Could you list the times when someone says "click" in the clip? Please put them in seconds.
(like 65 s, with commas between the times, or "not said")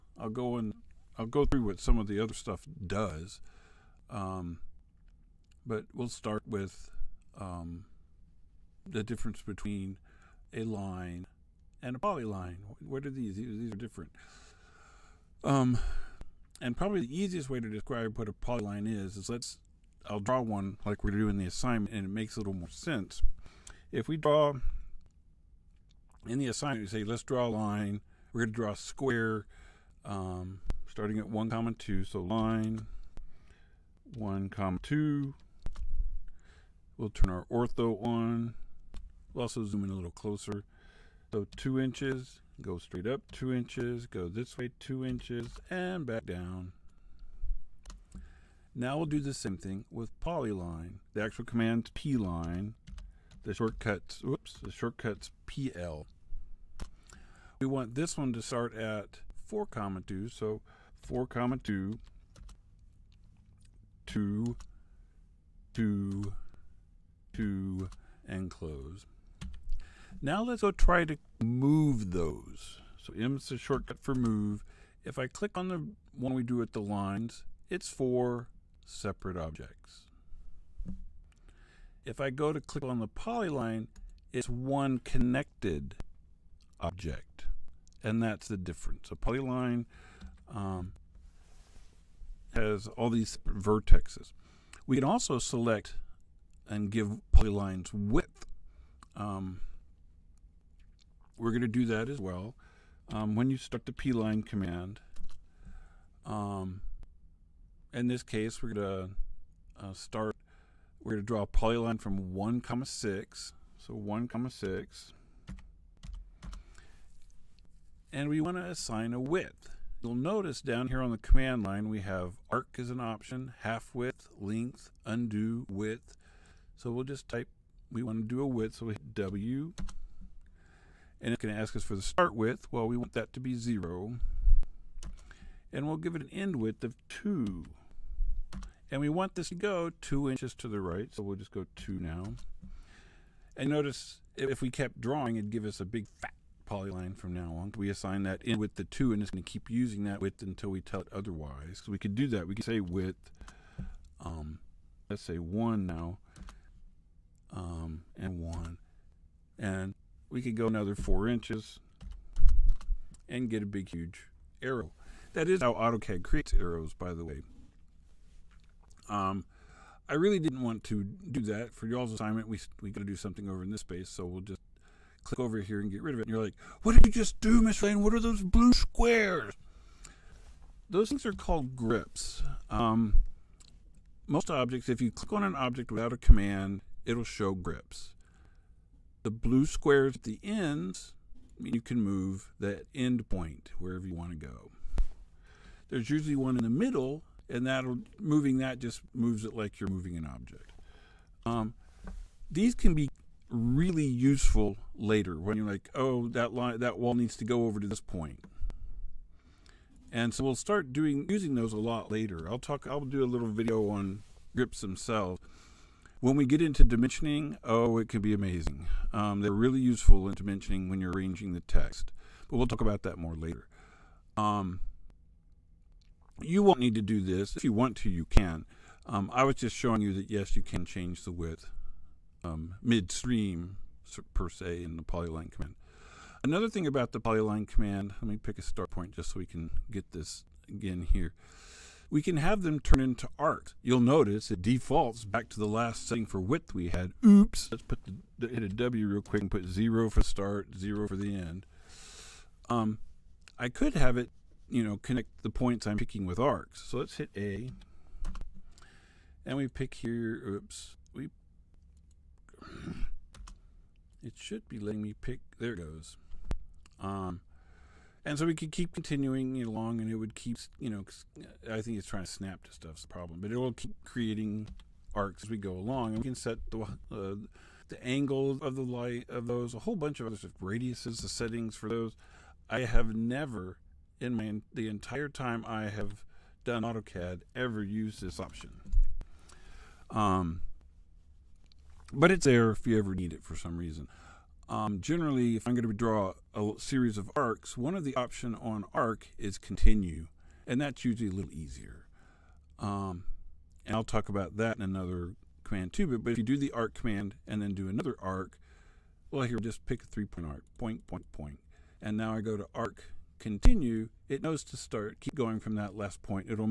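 75 s, 82 s, 175 s, 185 s.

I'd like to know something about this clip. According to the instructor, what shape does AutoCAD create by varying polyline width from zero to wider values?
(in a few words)
Arrows.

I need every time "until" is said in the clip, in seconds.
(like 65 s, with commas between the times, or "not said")
150 s.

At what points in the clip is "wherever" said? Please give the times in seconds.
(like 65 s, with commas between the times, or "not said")
193 s.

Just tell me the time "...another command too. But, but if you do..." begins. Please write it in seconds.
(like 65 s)
304 s.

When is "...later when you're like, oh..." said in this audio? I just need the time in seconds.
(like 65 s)
204 s.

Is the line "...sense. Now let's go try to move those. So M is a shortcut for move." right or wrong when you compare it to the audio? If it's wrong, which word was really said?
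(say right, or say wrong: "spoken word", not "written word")
wrong: "close", not "sense".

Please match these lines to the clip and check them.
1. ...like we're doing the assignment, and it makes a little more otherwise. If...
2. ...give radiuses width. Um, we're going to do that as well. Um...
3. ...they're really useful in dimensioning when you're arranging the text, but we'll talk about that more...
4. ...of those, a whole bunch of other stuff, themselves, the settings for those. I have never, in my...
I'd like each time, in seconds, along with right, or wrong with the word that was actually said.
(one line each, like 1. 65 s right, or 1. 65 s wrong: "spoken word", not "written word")
1. 20 s wrong: "sense", not "otherwise"
2. 96 s wrong: "polylines", not "radiuses"
3. 219 s right
4. 279 s wrong: "radiuses", not "themselves".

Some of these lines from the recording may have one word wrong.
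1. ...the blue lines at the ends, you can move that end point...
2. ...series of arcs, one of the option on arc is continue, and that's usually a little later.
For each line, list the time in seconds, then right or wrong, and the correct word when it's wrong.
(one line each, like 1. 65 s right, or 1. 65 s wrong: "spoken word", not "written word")
1. 189 s wrong: "squares", not "lines"
2. 296 s wrong: "easier", not "later".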